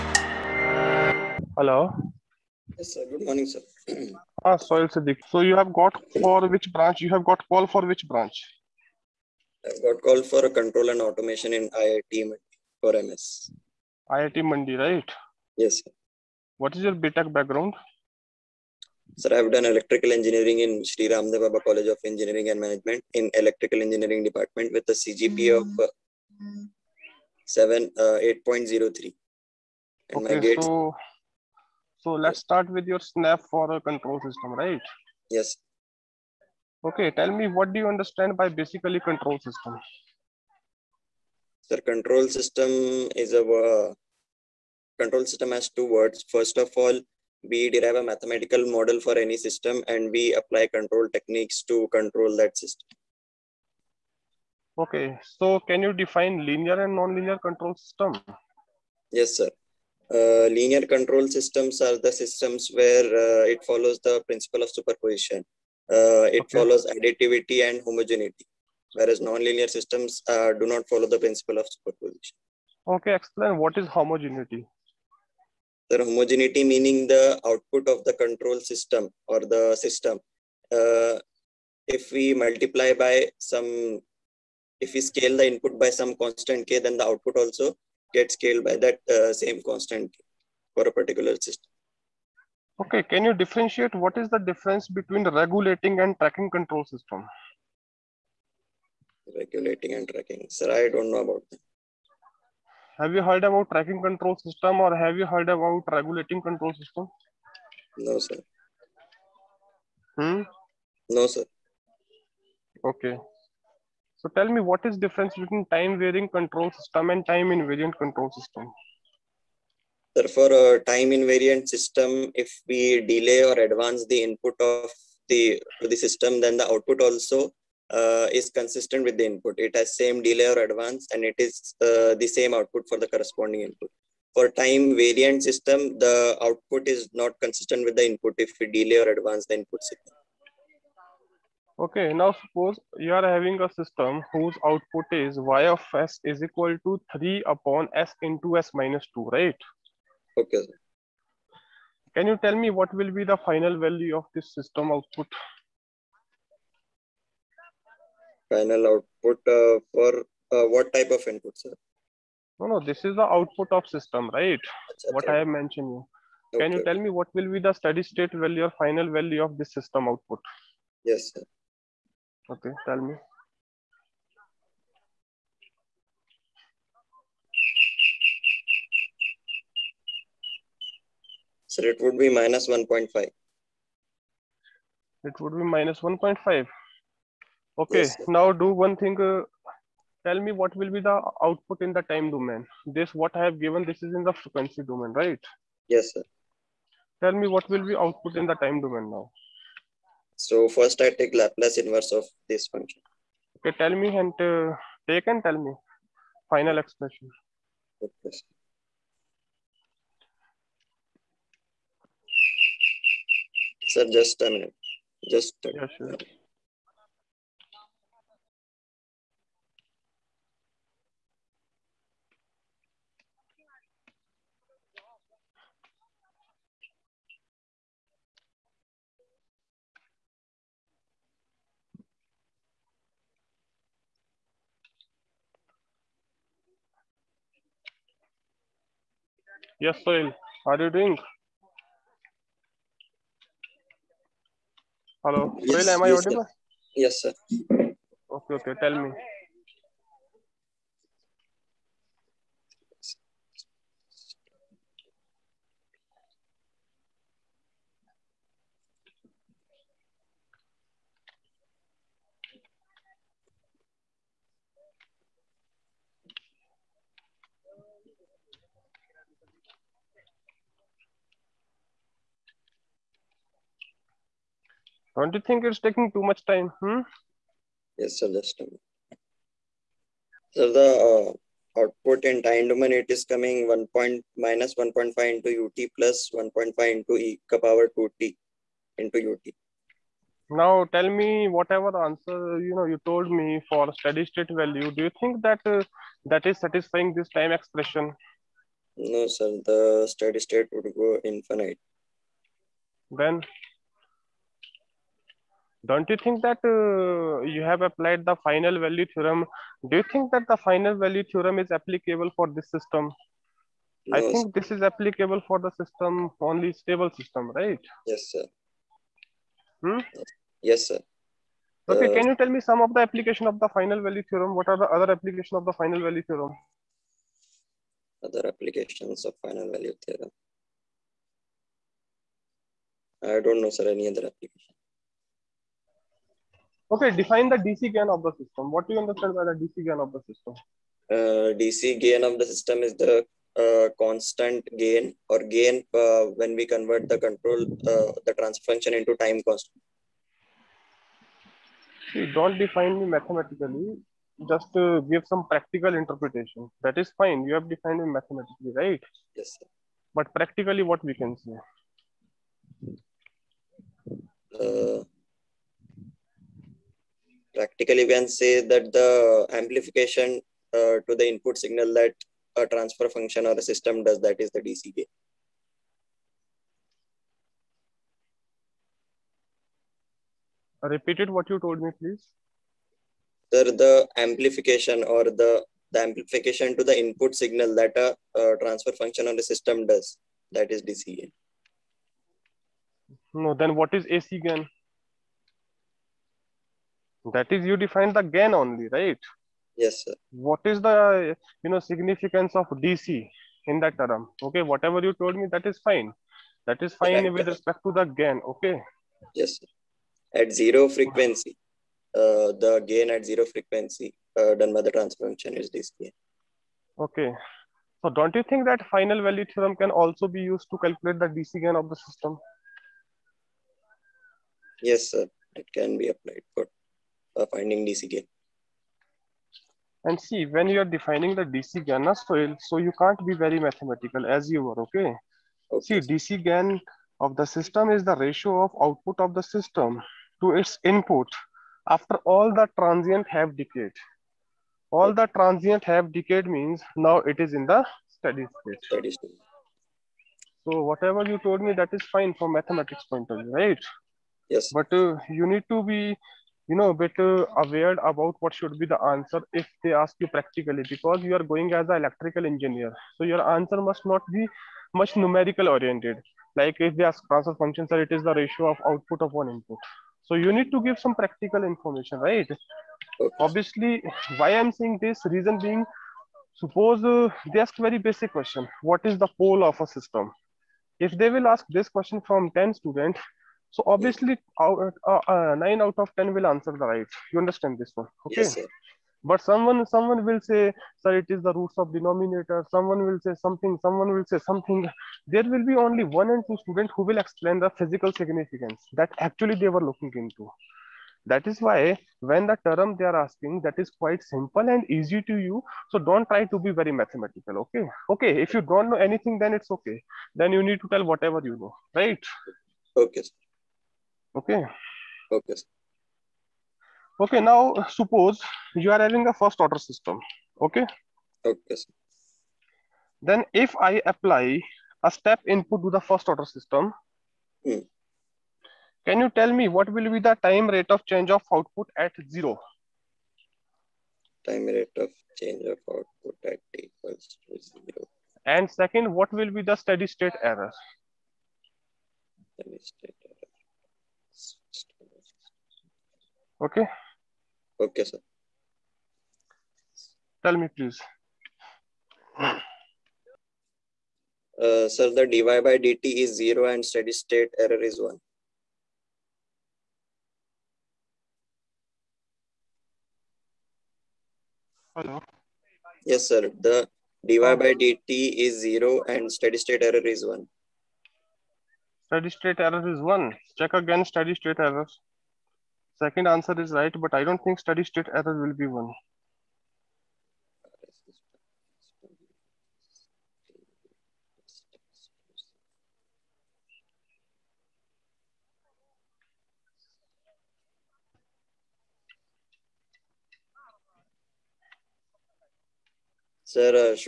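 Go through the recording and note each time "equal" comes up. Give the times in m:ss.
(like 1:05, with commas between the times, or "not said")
2:26, 8:56.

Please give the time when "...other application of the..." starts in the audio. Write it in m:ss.
5:24.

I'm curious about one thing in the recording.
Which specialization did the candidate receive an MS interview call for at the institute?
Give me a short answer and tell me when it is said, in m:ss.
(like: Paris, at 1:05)
Control and automation, at 0:10.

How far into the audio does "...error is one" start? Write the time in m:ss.
9:32.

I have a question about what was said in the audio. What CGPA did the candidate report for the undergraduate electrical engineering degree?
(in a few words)
8.03.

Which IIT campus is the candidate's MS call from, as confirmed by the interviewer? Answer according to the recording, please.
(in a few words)
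IIT Mandi.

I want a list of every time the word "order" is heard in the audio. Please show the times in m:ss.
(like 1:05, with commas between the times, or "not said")
8:39, 8:46.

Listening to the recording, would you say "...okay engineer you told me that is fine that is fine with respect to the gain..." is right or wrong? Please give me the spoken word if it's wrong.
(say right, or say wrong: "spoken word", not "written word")
wrong: "whatever", not "engineer".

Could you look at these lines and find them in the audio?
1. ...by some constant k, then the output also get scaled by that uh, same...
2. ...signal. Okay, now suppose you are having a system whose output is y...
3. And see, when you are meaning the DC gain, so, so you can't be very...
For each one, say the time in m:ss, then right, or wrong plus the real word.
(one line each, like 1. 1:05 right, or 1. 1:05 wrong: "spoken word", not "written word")
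1. 1:25 right
2. 2:19 right
3. 7:10 wrong: "defining", not "meaning".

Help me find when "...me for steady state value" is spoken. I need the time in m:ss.
4:53.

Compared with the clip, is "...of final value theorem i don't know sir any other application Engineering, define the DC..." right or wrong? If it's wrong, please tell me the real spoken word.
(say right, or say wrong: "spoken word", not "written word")
wrong: "Okay", not "Engineering".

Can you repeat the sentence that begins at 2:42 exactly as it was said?
No, no, this is the output of system, right?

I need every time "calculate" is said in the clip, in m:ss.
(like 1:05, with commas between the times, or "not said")
7:00.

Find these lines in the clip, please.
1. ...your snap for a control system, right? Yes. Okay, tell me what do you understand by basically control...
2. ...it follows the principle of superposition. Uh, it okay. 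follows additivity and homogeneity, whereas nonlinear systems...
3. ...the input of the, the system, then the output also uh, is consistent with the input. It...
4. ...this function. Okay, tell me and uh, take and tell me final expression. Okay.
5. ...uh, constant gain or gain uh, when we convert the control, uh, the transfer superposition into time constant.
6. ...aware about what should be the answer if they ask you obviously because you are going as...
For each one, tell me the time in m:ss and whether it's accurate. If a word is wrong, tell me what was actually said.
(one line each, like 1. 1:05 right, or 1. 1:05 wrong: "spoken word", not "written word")
1. 0:32 right
2. 1:03 right
3. 2:04 right
4. 3:22 right
5. 5:43 wrong: "function", not "superposition"
6. 7:37 wrong: "practically", not "obviously".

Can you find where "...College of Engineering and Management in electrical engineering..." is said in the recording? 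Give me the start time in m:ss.
0:21.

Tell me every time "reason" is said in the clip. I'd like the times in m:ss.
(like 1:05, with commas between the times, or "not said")
7:55.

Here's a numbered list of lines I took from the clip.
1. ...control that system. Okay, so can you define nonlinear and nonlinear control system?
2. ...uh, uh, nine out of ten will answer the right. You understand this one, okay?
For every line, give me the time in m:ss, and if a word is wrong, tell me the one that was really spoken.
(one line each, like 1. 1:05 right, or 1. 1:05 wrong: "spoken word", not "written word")
1. 0:51 wrong: "linear", not "nonlinear"
2. 8:05 right.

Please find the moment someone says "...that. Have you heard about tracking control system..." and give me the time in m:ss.
1:41.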